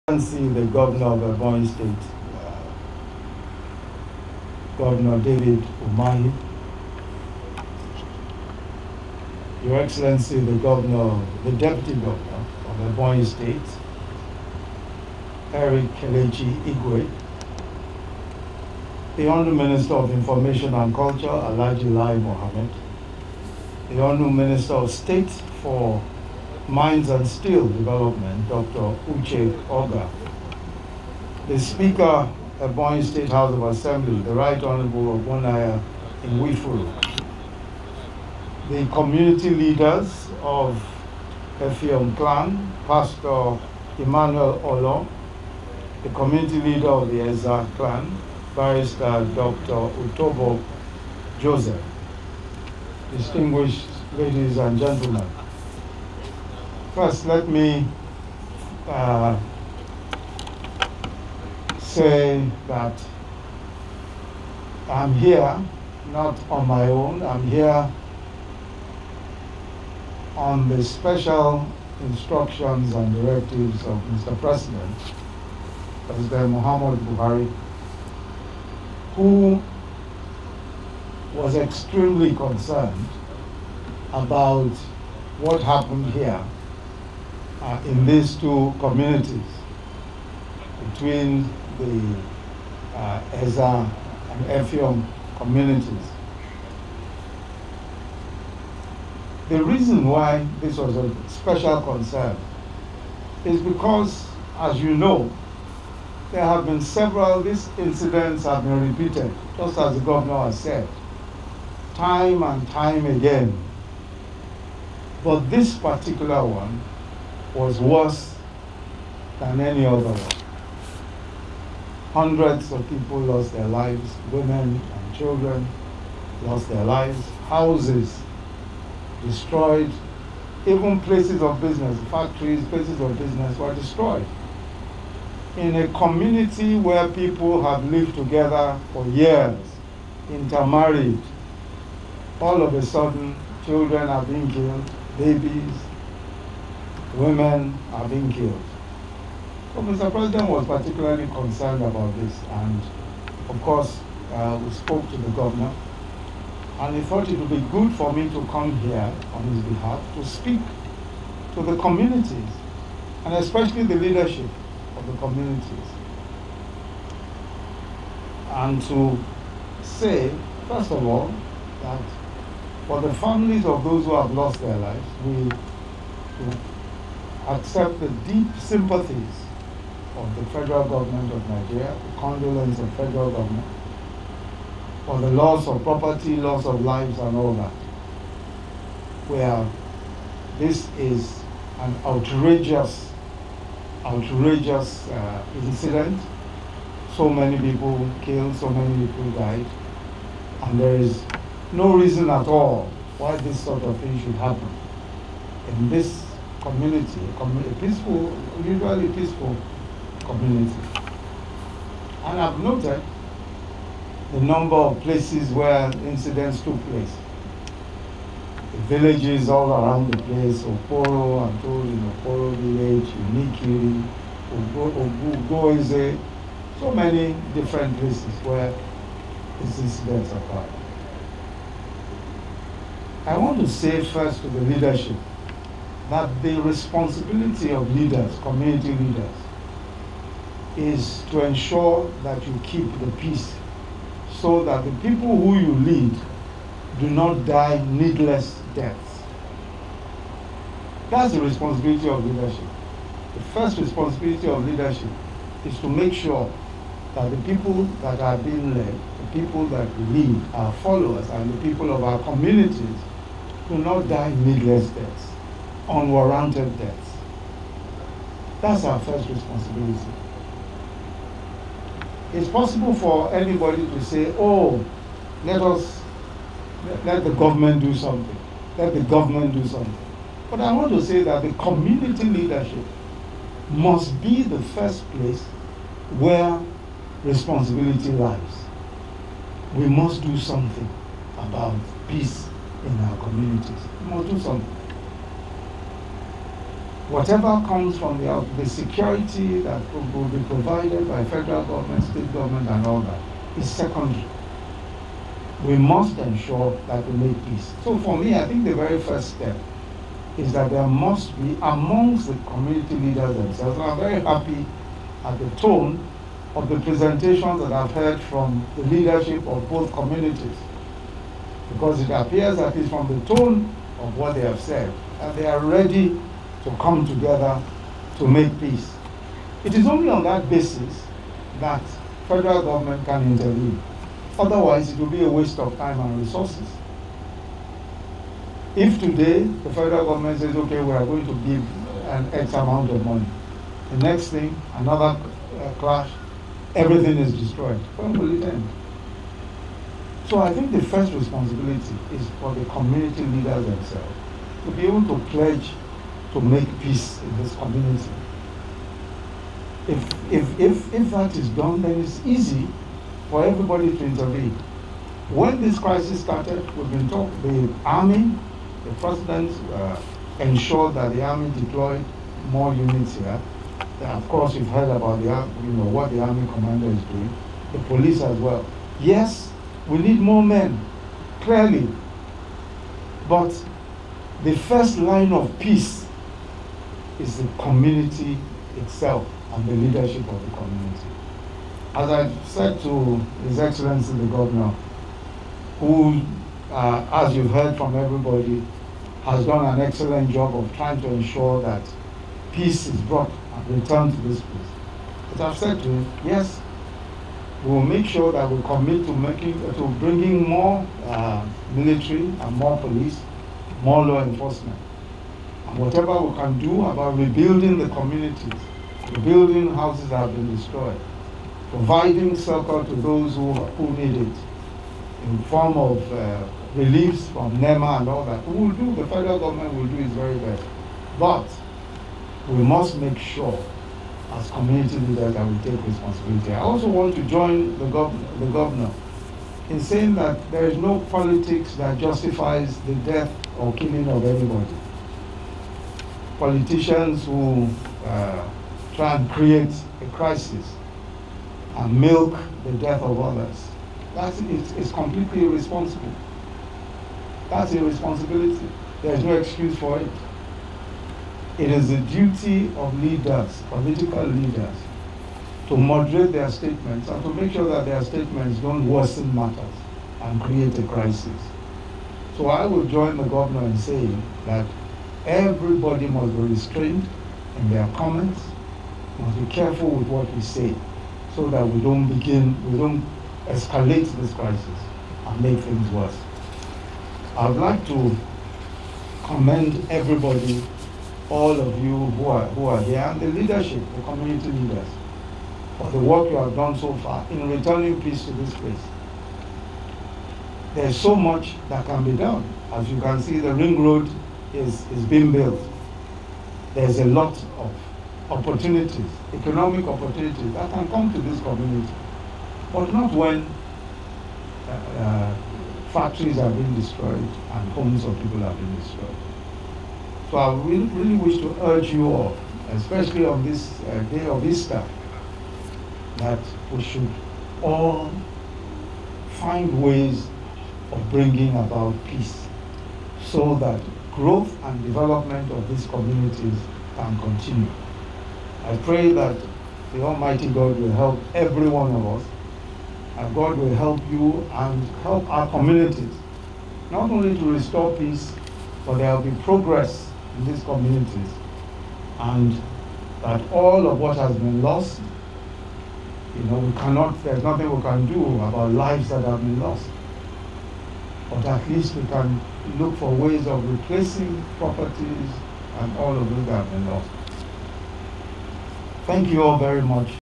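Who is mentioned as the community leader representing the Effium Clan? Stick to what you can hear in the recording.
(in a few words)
Pastor Emmanuel Olo.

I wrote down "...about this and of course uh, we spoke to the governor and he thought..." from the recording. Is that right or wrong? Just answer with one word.
right.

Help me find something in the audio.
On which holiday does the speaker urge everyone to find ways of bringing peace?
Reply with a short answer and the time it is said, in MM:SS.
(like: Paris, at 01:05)
Easter, at 08:44.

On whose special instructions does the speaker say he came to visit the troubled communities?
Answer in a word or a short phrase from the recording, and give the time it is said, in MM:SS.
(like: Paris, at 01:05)
President Muhammad Buhari, at 01:16.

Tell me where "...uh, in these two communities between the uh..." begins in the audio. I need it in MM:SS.
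01:27.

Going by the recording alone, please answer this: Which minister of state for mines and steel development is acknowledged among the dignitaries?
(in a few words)
Dr. Uche Ogah.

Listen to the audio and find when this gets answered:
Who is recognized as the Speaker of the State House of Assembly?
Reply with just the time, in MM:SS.
00:35.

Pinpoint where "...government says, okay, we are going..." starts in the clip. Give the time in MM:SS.
05:40.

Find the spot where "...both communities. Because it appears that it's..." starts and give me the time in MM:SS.
05:19.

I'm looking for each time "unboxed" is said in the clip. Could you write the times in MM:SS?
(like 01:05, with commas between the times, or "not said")
not said.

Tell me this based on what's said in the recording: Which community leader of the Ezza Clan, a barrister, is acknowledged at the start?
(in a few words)
Utobo Joseph.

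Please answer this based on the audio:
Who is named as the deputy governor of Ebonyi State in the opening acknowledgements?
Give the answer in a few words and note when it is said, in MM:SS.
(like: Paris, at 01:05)
Eric Kelechi Igwe, at 00:15.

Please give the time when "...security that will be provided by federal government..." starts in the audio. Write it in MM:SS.
04:58.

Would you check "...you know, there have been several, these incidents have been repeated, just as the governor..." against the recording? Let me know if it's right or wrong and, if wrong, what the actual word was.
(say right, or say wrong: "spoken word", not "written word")
right.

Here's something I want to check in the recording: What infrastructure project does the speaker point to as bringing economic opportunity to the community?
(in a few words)
the ring road.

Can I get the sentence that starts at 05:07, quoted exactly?
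So for me, I think the very first step is that there must be amongst the community leaders themselves.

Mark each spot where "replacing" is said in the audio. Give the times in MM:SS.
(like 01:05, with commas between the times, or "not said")
09:23.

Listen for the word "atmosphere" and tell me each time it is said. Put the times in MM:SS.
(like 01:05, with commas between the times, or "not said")
not said.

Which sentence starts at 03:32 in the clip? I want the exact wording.
And I've noted the number of places where incidents took place.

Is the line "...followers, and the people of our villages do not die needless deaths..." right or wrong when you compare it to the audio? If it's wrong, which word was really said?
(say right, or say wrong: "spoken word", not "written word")
wrong: "communities", not "villages".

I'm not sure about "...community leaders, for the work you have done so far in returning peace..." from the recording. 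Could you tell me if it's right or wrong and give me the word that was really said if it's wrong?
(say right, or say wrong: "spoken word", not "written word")
right.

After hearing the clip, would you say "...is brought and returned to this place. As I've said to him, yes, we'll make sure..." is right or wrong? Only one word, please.
right.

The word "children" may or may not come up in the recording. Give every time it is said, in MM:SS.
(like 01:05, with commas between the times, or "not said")
02:05, 02:23.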